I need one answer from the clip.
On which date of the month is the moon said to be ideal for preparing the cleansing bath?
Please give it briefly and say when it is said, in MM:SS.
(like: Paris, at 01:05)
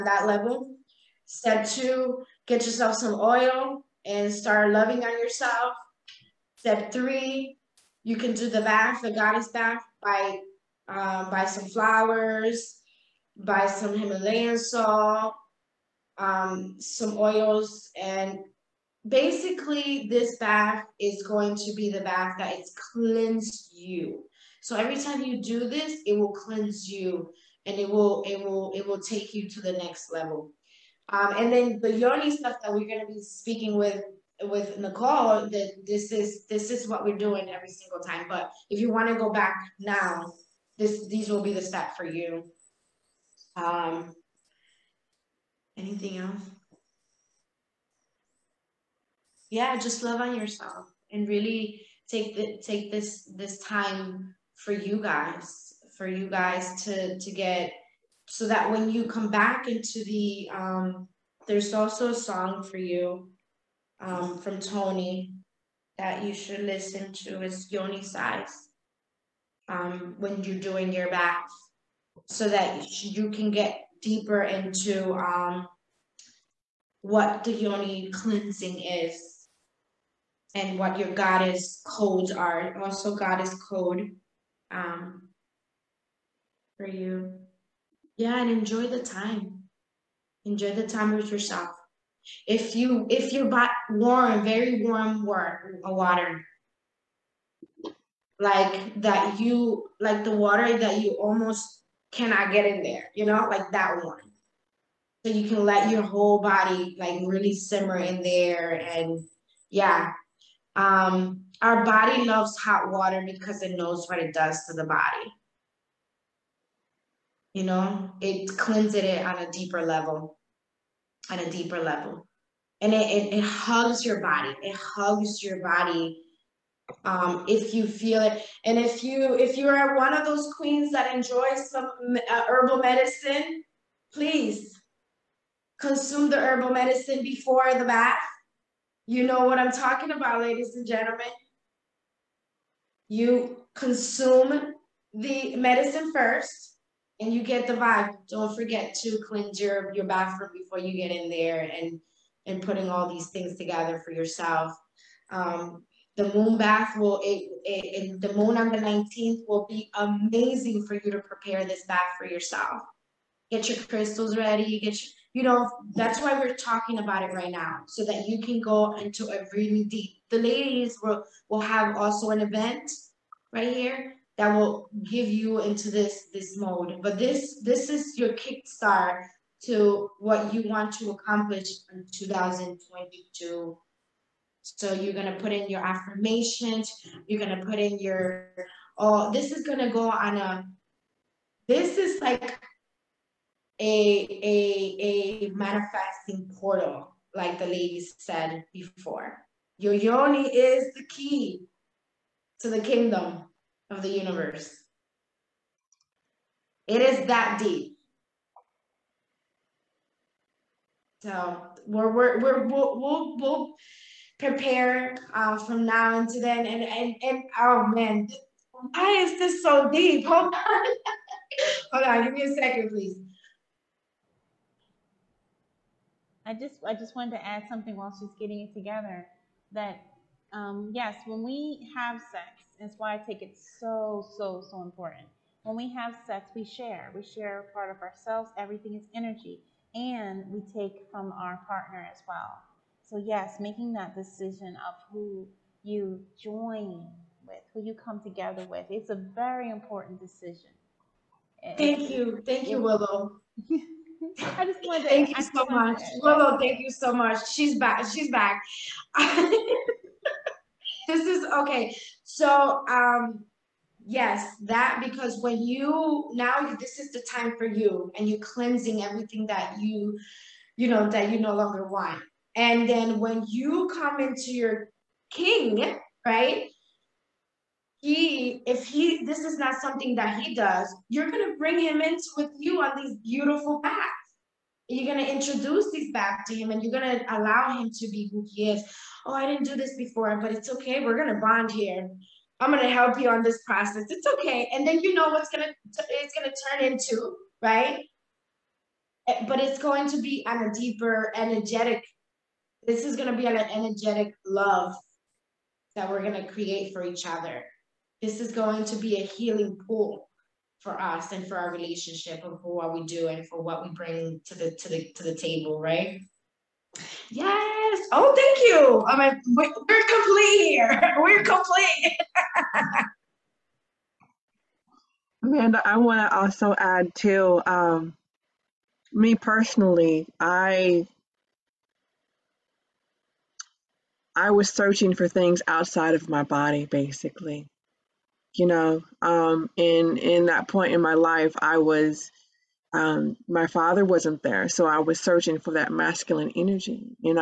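19th, at 02:38.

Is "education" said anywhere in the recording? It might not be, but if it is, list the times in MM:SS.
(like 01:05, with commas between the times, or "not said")
not said.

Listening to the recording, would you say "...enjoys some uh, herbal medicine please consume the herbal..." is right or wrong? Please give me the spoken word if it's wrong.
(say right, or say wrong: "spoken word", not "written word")
right.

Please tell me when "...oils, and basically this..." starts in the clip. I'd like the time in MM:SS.
00:17.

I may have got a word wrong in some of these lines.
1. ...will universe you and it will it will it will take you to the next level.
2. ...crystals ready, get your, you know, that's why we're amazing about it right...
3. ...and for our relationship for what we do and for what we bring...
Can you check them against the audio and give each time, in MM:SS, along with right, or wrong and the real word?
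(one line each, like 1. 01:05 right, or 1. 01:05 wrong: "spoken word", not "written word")
1. 00:26 wrong: "cleanse", not "universe"
2. 02:43 wrong: "talking", not "amazing"
3. 05:11 right.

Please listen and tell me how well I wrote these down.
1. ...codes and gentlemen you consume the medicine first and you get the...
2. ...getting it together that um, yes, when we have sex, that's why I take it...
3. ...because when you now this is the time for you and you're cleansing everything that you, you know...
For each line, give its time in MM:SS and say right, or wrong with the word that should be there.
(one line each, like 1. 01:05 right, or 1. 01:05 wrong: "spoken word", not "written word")
1. 02:20 wrong: "ladies", not "codes"
2. 03:48 right
3. 04:25 right.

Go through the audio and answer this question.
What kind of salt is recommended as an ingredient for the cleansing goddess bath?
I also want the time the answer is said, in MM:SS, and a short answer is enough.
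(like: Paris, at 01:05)
Himalayan salt, at 00:13.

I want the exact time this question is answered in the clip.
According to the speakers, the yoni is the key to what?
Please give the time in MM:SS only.
03:22.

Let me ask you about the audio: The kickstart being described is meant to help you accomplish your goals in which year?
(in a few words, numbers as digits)
2022.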